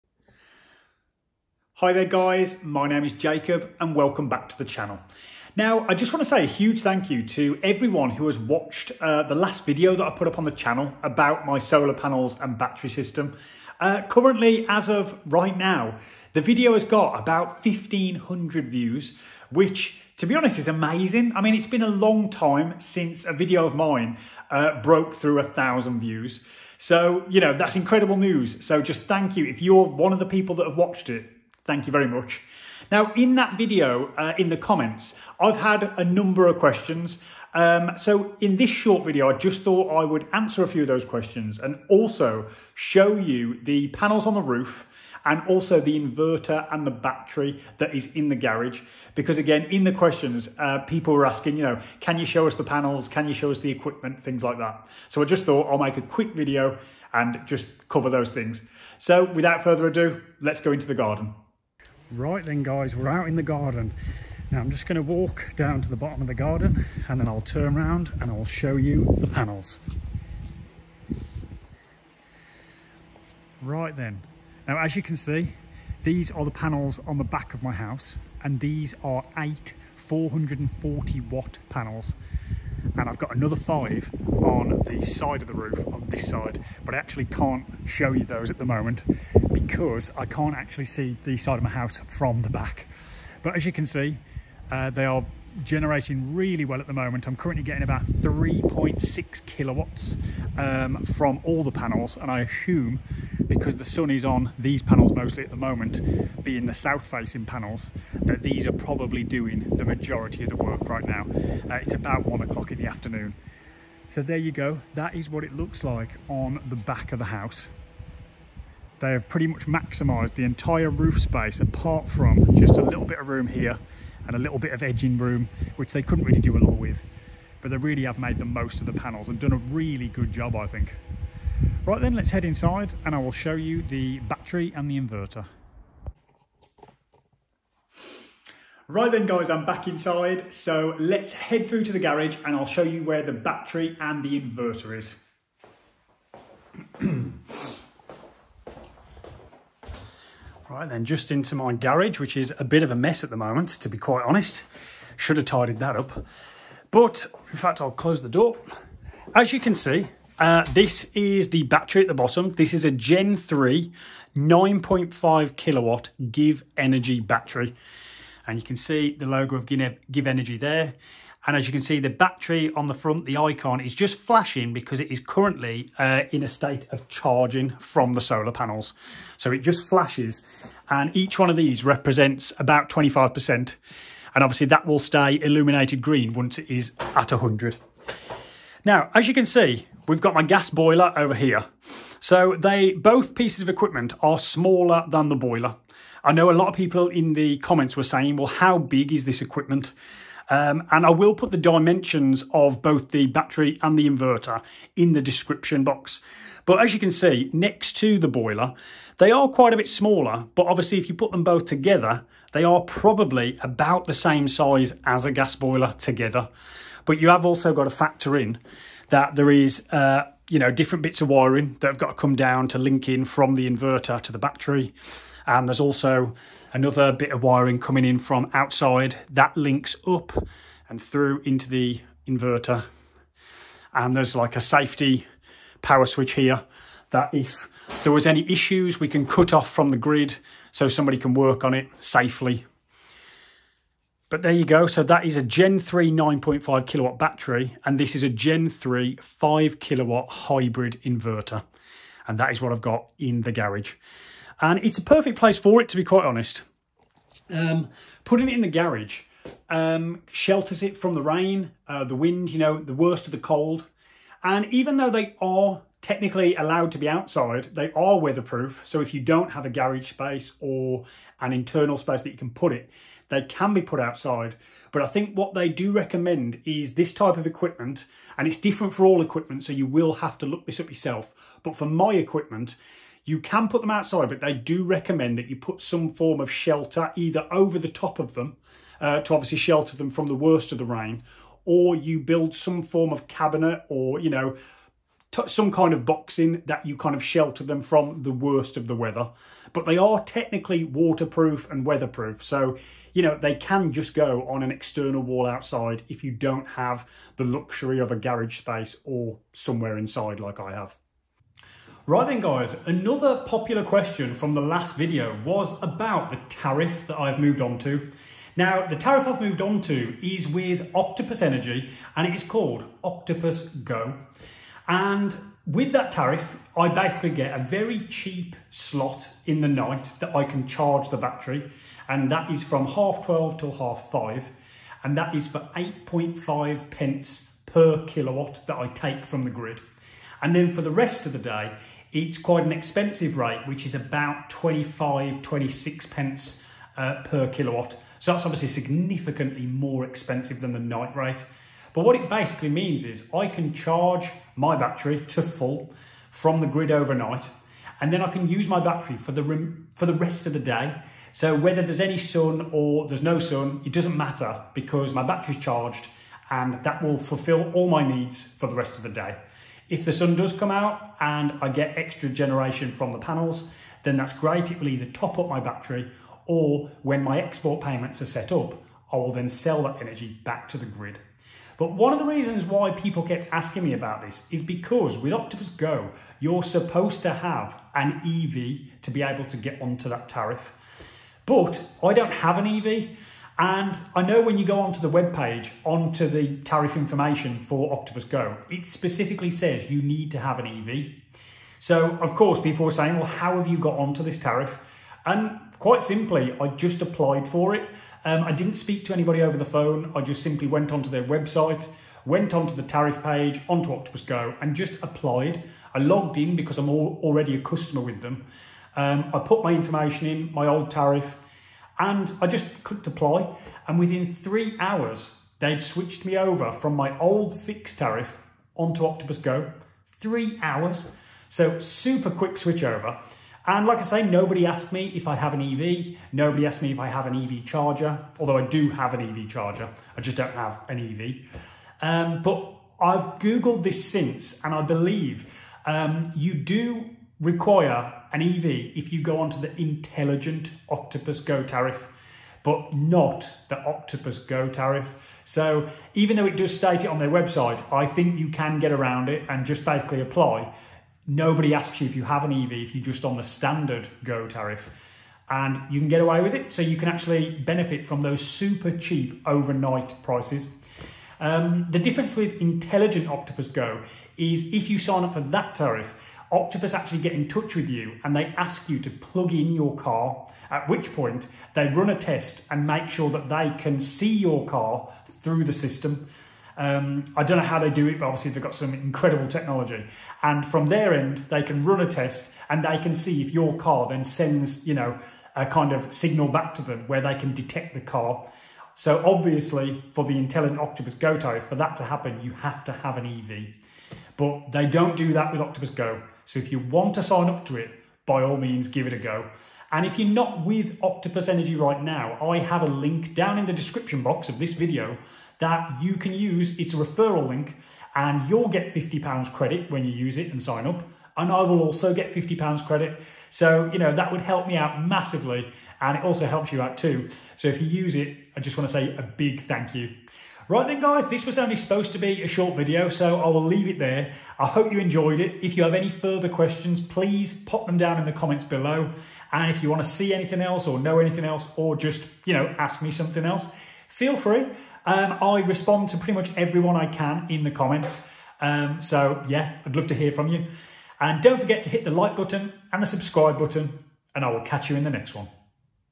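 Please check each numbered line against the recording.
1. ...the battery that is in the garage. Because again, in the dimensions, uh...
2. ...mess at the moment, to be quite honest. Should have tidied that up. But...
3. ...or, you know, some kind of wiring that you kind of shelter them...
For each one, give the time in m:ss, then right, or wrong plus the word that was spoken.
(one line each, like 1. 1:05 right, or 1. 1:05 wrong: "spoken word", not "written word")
1. 0:46 wrong: "questions", not "dimensions"
2. 2:32 right
3. 4:53 wrong: "boxing", not "wiring".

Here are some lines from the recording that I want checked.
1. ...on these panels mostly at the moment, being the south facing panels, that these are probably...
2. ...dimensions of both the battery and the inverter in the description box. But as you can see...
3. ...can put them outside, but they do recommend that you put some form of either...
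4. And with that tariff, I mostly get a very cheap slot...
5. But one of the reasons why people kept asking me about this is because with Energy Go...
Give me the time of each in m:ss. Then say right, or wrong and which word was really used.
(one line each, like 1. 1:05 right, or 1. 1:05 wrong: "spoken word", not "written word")
1. 1:44 right
2. 3:21 right
3. 4:43 wrong: "shelter", not "either"
4. 5:24 wrong: "basically", not "mostly"
5. 6:21 wrong: "Octopus", not "Energy".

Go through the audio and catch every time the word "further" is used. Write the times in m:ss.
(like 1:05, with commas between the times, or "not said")
0:59, 8:56.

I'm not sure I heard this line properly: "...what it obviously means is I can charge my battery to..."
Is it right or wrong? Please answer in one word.
wrong.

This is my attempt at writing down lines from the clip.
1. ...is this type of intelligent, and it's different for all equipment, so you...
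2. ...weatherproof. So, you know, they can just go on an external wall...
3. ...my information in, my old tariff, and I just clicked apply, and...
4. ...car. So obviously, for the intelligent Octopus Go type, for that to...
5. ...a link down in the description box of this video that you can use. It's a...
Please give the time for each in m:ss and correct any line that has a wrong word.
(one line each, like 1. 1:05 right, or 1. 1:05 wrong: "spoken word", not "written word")
1. 4:36 wrong: "equipment", not "intelligent"
2. 5:01 right
3. 6:59 right
4. 8:18 right
5. 8:32 right.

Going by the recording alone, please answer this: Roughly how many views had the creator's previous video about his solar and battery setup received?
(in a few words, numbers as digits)
1,500.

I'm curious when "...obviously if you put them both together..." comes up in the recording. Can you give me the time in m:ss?
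3:30.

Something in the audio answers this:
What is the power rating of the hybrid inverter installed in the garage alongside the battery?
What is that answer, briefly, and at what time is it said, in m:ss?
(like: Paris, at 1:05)
5 kilowatt, at 4:09.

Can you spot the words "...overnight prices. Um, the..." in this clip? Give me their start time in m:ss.
7:49.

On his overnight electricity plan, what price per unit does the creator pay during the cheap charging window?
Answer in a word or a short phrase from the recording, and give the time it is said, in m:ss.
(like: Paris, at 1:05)
8.5 pence, at 5:35.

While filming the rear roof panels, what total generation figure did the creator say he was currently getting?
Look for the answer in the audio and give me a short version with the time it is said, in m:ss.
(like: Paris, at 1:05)
3.6 kilowatts, at 1:38.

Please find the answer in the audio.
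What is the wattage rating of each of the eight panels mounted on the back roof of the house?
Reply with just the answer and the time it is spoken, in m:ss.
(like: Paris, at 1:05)
440 watts, at 1:19.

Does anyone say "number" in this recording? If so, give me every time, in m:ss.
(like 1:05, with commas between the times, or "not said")
0:36.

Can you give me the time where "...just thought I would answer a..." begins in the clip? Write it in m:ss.
0:39.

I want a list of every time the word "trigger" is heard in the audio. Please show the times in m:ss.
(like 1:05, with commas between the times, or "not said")
not said.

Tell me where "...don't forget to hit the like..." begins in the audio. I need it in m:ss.
9:11.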